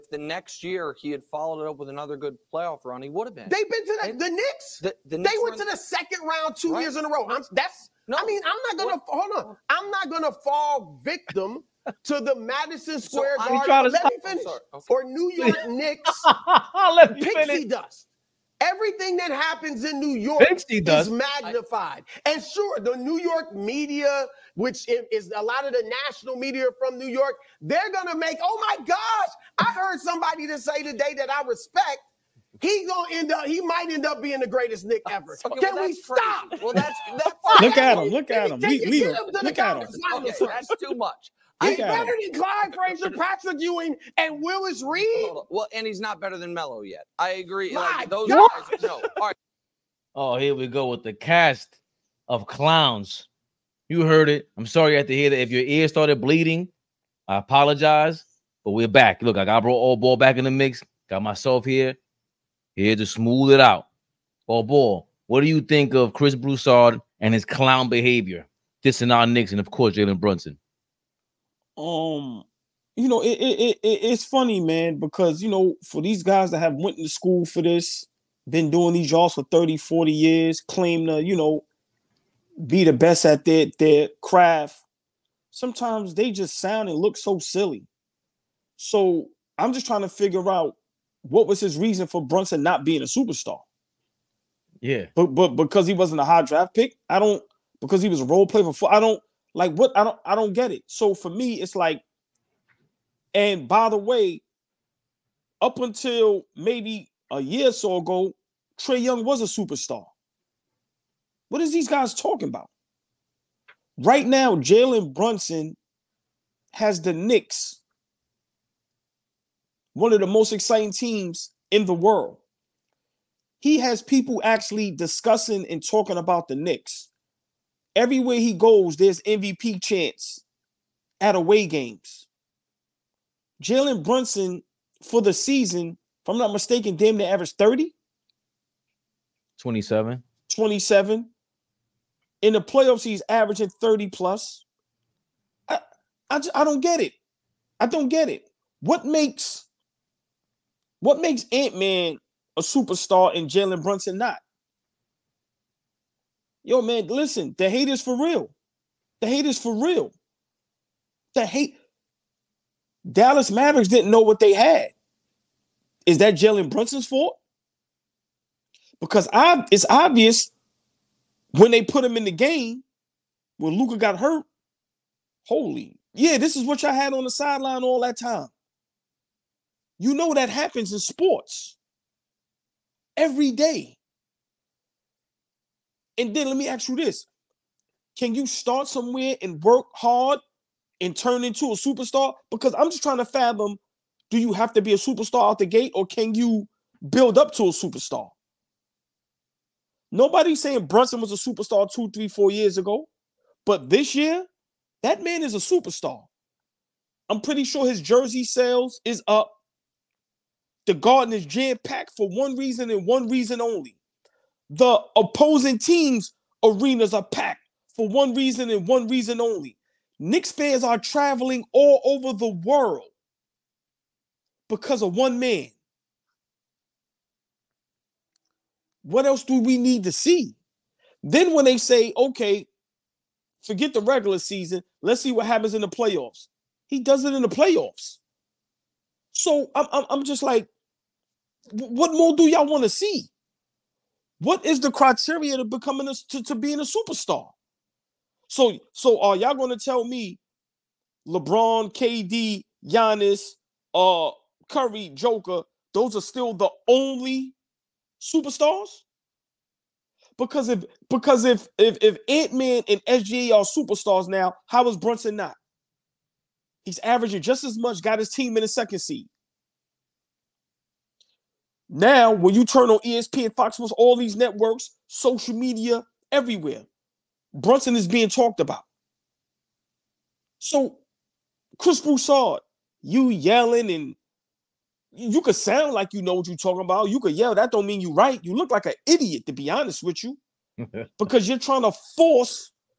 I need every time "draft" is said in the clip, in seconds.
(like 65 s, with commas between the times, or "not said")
96 s.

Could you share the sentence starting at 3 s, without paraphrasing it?
They've been to the, the Knicks.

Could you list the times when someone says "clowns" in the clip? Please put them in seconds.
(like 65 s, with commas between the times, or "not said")
52 s, 67 s.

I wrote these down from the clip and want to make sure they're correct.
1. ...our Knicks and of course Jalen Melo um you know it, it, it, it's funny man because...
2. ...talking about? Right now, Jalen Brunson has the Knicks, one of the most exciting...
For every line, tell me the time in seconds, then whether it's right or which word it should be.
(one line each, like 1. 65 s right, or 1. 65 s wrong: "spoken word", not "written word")
1. 69 s wrong: "Brunson", not "Melo"
2. 112 s right.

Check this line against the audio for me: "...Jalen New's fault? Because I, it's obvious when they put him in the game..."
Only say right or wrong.
wrong.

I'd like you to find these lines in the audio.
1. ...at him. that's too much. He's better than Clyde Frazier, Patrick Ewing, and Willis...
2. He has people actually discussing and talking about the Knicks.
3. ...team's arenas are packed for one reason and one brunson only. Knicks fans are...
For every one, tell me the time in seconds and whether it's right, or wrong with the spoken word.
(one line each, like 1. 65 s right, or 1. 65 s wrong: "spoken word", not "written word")
1. 39 s right
2. 123 s right
3. 215 s wrong: "reason", not "brunson".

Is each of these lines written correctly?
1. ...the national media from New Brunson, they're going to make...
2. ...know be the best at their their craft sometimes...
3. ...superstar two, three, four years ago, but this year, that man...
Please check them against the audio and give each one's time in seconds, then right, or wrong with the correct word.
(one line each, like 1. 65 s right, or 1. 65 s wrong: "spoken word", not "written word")
1. 25 s wrong: "York", not "Brunson"
2. 81 s right
3. 201 s right.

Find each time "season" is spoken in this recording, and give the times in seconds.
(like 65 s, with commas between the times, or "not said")
135 s, 234 s.